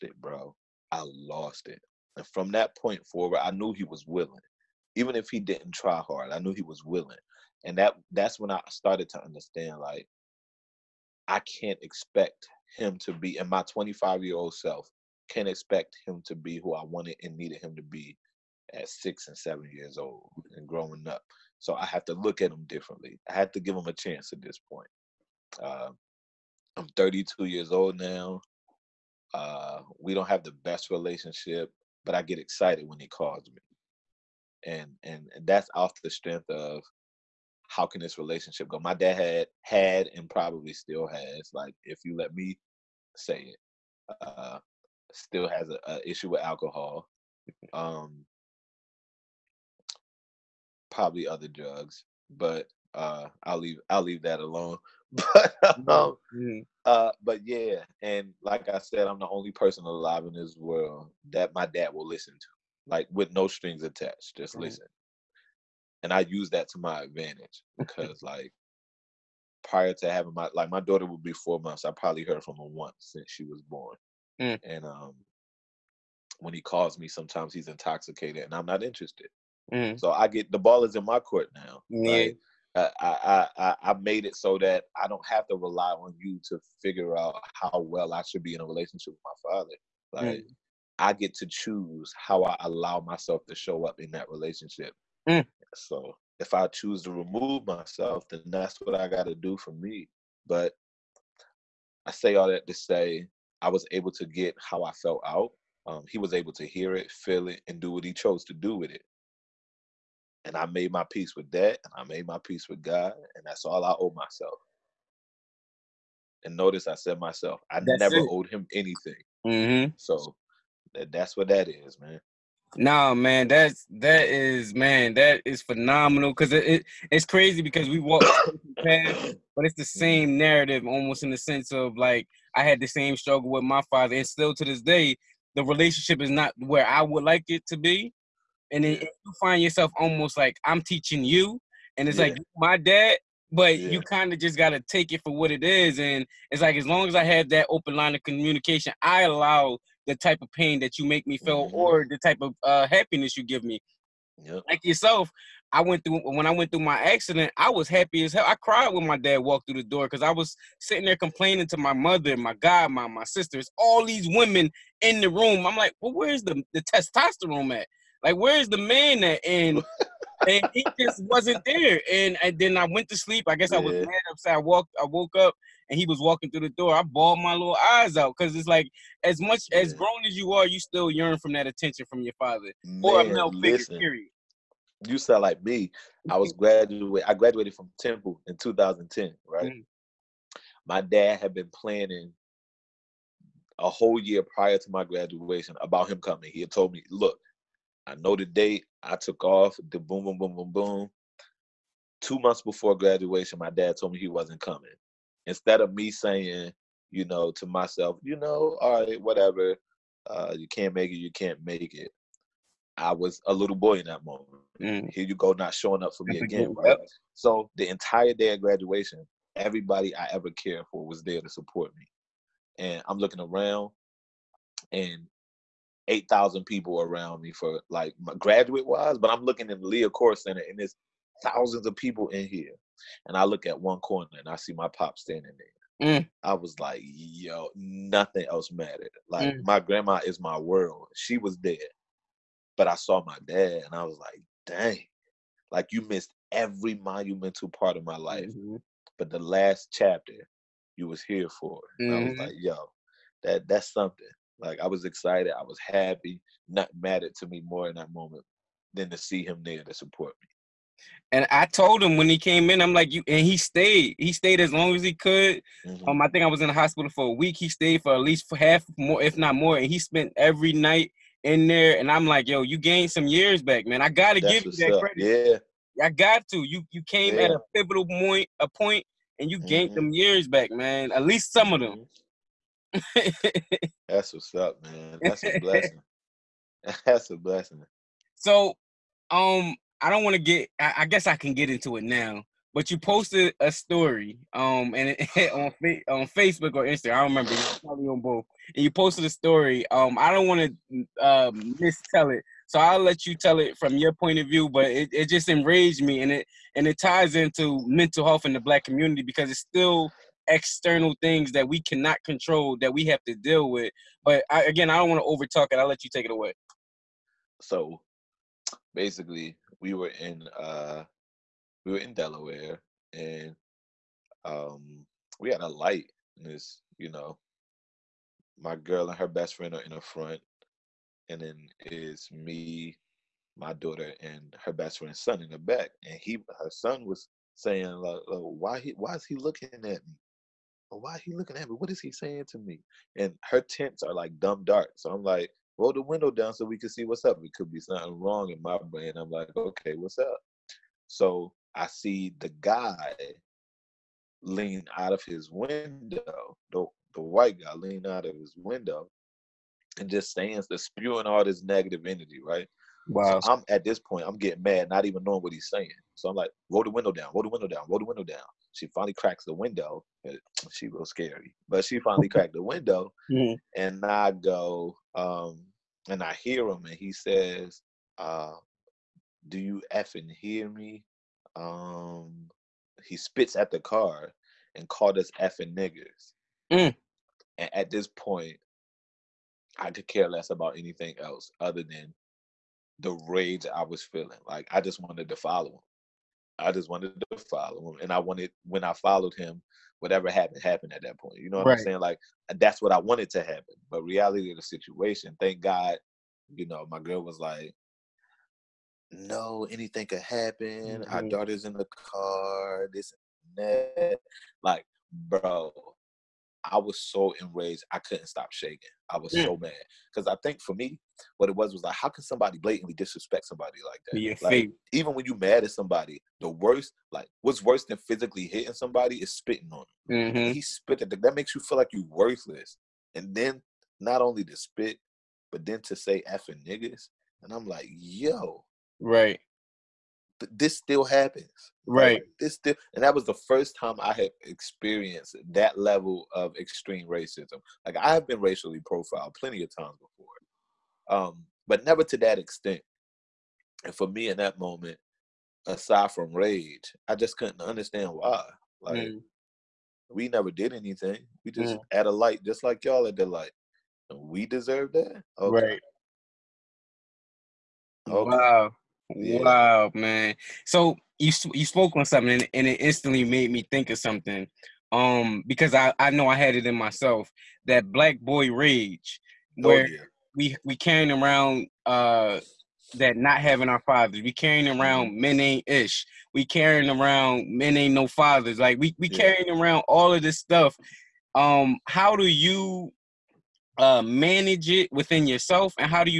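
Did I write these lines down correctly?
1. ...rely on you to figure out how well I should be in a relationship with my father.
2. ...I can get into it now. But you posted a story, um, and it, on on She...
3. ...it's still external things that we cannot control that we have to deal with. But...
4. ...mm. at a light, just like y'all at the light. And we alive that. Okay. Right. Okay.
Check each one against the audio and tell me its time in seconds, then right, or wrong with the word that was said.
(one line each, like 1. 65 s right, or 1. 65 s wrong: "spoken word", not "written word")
1. 85 s right
2. 291 s wrong: "Facebook", not "She"
3. 309 s right
4. 461 s wrong: "deserve", not "alive".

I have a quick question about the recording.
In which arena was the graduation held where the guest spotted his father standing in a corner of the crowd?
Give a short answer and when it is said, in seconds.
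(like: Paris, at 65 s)
Liacouras Center, at 229 s.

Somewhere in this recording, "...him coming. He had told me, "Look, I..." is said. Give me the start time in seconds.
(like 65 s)
196 s.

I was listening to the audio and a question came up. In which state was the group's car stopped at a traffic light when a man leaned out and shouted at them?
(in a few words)
Delaware.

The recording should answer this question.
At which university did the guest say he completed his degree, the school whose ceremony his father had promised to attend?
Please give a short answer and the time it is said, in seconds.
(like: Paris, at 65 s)
Temple, at 187 s.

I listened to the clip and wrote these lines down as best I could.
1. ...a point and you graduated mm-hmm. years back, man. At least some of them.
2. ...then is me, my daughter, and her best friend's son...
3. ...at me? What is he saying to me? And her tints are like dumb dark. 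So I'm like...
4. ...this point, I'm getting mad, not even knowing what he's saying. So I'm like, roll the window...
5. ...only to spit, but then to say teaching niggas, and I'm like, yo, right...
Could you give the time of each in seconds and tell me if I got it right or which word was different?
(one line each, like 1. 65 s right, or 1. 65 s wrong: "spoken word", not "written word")
1. 278 s wrong: "gained", not "graduated"
2. 331 s right
3. 341 s right
4. 363 s right
5. 434 s wrong: "effing", not "teaching".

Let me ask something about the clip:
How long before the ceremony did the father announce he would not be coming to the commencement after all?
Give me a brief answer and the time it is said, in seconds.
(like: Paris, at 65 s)
2 months, at 202 s.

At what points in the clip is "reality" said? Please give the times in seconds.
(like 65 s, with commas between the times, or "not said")
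404 s.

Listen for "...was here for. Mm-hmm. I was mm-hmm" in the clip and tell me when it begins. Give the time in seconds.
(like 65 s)
251 s.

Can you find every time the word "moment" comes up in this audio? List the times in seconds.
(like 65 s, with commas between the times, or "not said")
214 s, 258 s, 454 s.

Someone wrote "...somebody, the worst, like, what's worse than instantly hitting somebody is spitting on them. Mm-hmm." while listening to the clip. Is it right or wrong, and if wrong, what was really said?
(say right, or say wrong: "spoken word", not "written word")
wrong: "physically", not "instantly".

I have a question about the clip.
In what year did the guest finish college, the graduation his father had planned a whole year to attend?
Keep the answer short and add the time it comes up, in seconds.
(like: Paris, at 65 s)
2010, at 188 s.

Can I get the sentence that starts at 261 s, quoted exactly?
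And I told him when he came in, I'm like, you and he stayed.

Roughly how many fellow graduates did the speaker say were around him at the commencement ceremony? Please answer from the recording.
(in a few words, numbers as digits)
8,000.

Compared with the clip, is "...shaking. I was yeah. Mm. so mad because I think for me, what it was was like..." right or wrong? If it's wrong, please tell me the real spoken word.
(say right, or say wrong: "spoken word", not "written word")
right.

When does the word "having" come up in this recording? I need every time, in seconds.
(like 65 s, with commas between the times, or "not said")
70 s, 483 s.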